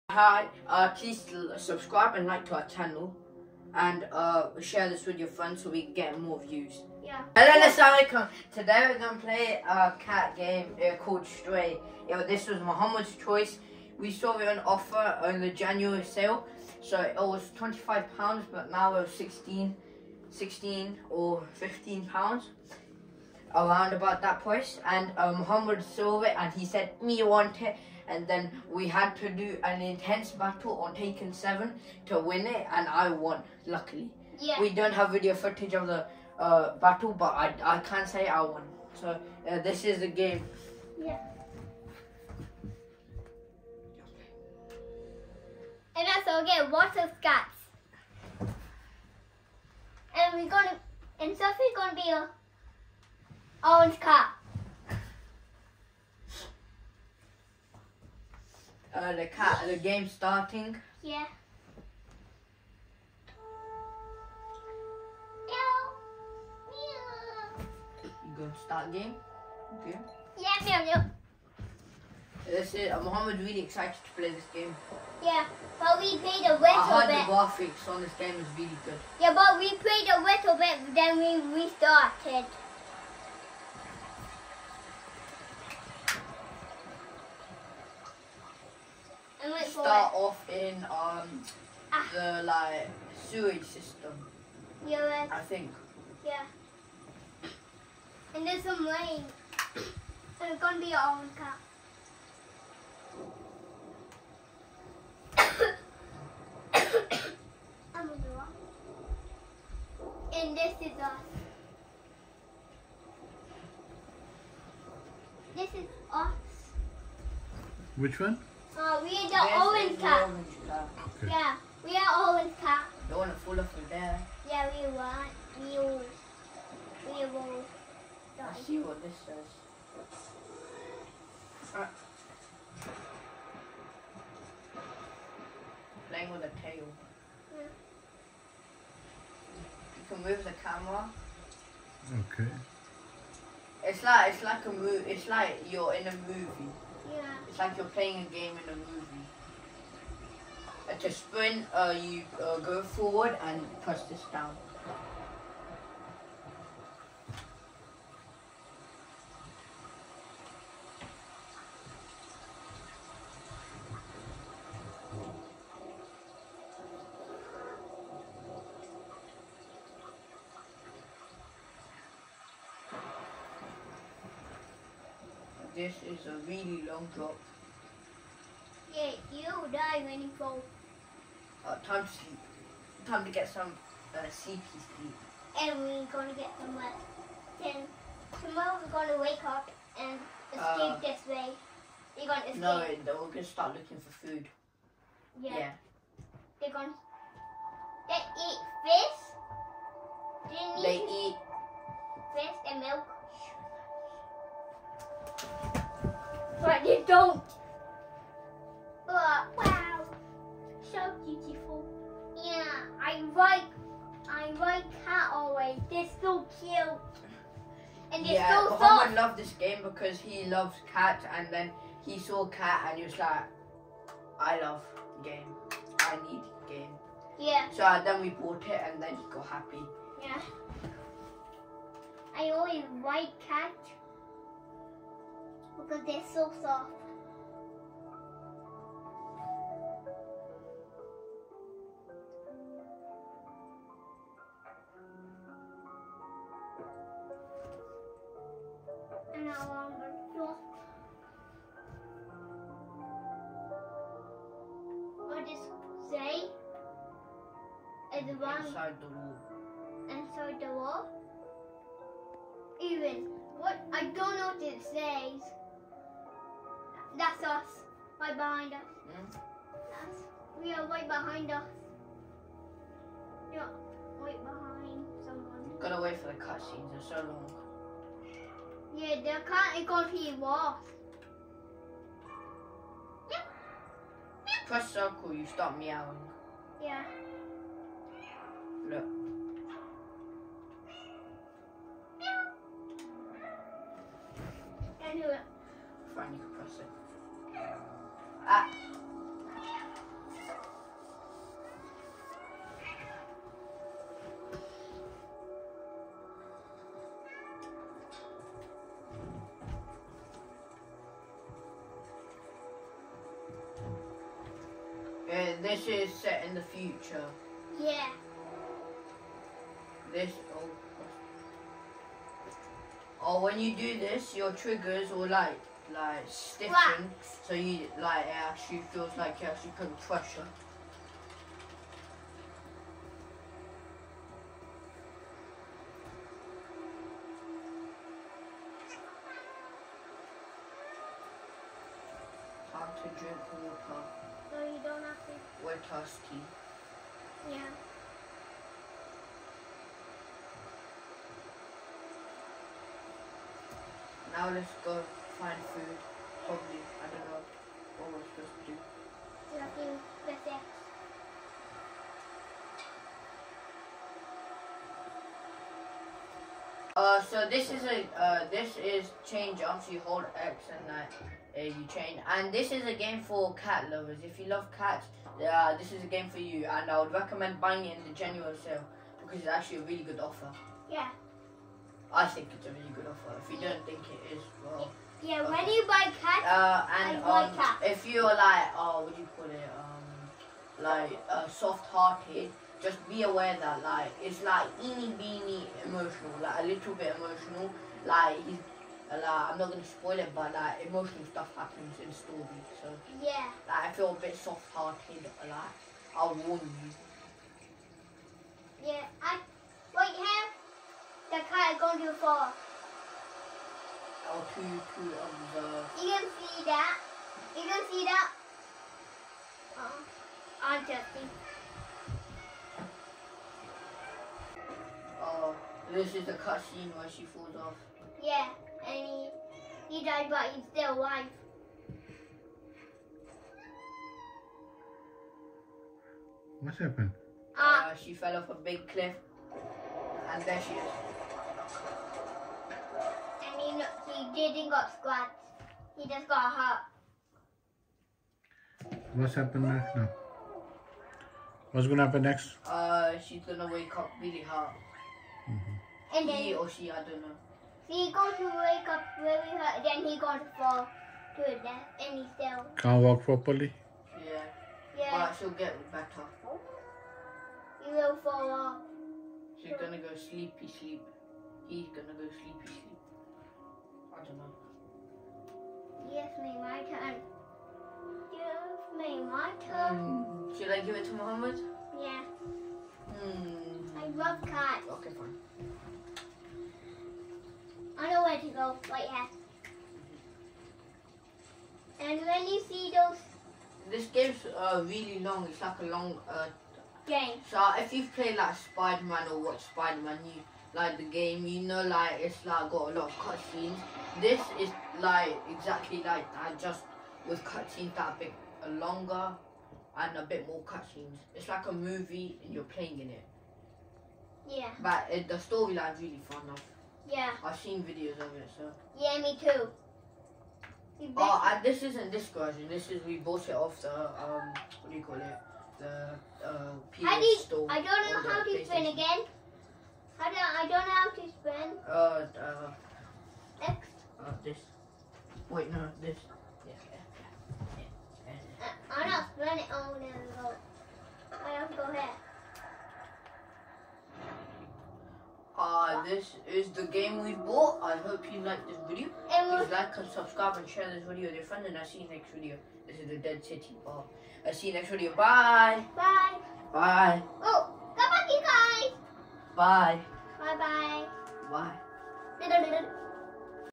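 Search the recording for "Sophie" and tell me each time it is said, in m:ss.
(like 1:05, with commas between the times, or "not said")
0:51.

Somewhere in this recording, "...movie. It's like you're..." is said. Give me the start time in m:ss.
2:24.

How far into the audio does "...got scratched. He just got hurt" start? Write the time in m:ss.
7:24.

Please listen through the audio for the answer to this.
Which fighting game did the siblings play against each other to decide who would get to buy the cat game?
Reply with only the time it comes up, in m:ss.
0:30.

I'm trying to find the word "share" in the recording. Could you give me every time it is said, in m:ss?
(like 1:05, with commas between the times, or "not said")
0:04, 9:10.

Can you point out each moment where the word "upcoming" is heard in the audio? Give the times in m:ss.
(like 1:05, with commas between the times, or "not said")
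not said.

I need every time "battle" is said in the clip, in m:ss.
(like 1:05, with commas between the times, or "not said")
0:30, 0:36.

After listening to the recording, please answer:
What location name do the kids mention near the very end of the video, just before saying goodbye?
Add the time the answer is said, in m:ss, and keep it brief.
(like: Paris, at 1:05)
Dead City Bar, at 9:13.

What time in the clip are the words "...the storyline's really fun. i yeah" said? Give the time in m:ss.
8:35.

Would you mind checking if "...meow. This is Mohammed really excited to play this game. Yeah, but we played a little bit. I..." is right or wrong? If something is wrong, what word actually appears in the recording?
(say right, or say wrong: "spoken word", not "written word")
right.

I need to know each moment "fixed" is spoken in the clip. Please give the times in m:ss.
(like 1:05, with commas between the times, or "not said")
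not said.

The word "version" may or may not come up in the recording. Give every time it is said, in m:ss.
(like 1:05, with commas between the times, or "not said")
8:42.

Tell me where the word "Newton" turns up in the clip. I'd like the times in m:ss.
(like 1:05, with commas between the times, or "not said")
not said.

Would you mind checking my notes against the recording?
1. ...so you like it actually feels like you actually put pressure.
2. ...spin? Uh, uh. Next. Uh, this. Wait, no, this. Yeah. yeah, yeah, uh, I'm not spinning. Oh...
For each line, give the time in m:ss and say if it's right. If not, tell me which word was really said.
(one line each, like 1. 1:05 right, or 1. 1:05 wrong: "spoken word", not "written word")
1. 5:27 right
2. 8:51 right.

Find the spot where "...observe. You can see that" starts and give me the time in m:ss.
6:55.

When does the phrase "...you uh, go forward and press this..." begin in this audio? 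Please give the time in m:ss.
2:32.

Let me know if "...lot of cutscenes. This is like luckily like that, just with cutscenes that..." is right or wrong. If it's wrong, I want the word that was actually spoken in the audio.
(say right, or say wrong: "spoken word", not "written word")
wrong: "exactly", not "luckily".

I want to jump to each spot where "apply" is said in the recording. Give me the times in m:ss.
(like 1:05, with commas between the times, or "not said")
not said.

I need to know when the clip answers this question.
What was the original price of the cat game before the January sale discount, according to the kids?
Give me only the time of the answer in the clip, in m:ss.
0:17.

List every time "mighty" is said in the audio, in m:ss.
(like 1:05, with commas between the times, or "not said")
not said.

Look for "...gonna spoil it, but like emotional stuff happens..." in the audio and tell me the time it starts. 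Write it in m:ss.
6:39.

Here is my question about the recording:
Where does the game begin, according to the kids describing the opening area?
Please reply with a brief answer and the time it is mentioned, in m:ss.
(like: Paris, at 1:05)
Sewage system, at 1:33.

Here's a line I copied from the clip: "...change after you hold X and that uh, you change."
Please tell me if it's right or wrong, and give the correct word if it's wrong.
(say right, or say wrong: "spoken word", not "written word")
right.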